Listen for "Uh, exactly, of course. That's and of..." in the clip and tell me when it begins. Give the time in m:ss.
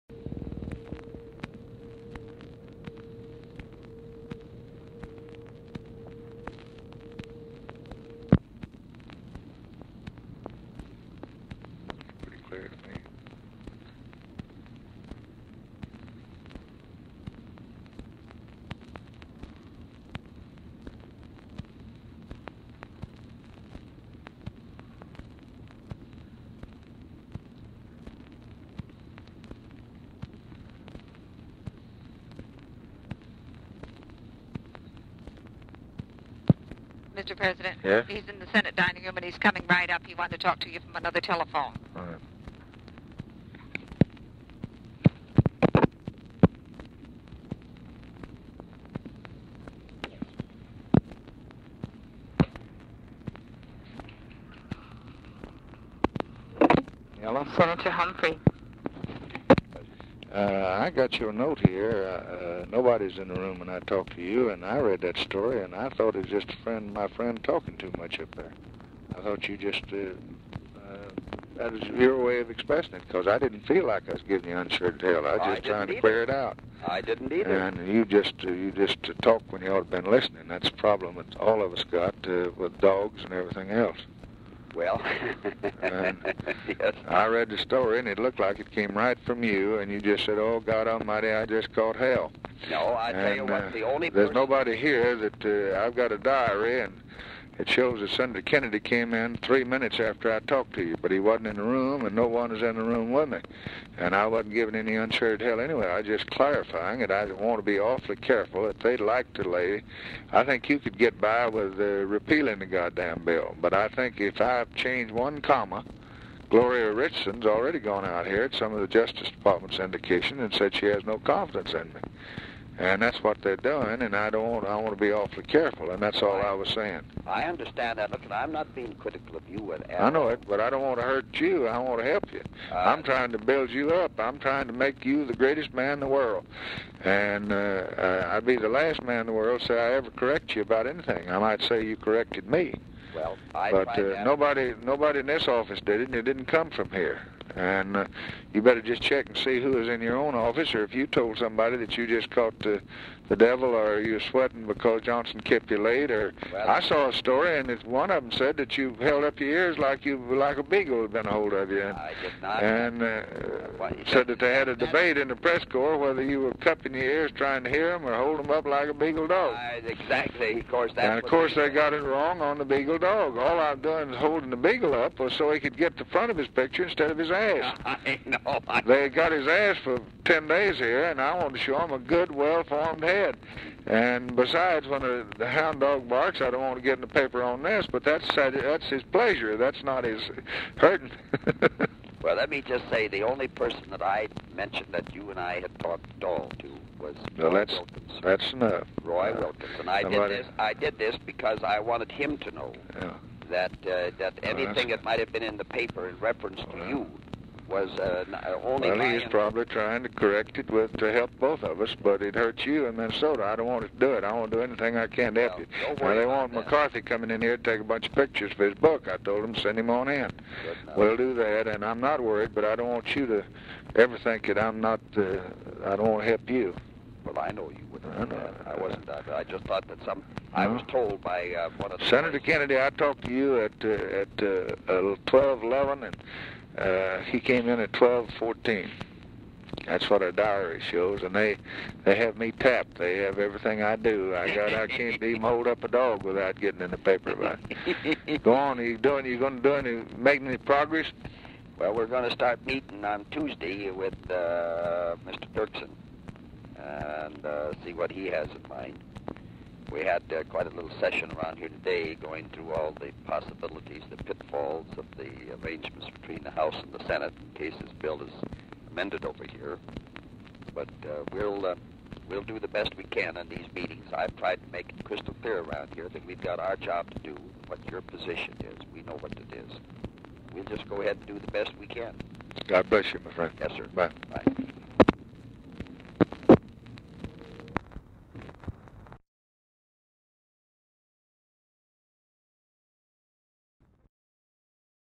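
2:49.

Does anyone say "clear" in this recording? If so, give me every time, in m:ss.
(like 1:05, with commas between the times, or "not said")
1:15, 4:35.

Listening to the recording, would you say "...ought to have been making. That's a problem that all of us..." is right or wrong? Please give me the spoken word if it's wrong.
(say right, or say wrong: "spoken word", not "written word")
wrong: "listening", not "making".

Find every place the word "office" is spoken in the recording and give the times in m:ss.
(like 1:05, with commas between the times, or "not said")
2:25, 2:30.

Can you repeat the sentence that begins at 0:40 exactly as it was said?
He wanted to talk to you from another telephone.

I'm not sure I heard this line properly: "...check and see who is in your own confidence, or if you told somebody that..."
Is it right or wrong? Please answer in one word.
wrong.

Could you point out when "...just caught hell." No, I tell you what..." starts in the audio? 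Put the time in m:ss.
1:31.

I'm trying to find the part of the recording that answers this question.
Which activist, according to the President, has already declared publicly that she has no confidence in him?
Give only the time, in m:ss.
1:56.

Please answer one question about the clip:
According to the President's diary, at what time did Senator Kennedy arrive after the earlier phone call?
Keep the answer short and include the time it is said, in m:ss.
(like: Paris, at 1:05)
12:14, at 3:57.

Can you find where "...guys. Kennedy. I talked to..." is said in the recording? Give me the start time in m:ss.
3:52.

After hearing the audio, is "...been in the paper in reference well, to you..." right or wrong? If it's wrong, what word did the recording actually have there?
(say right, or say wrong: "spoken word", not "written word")
right.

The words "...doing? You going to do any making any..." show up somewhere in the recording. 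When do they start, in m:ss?
4:08.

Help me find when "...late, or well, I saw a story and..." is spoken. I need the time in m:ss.
2:35.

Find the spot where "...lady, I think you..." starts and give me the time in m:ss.
1:49.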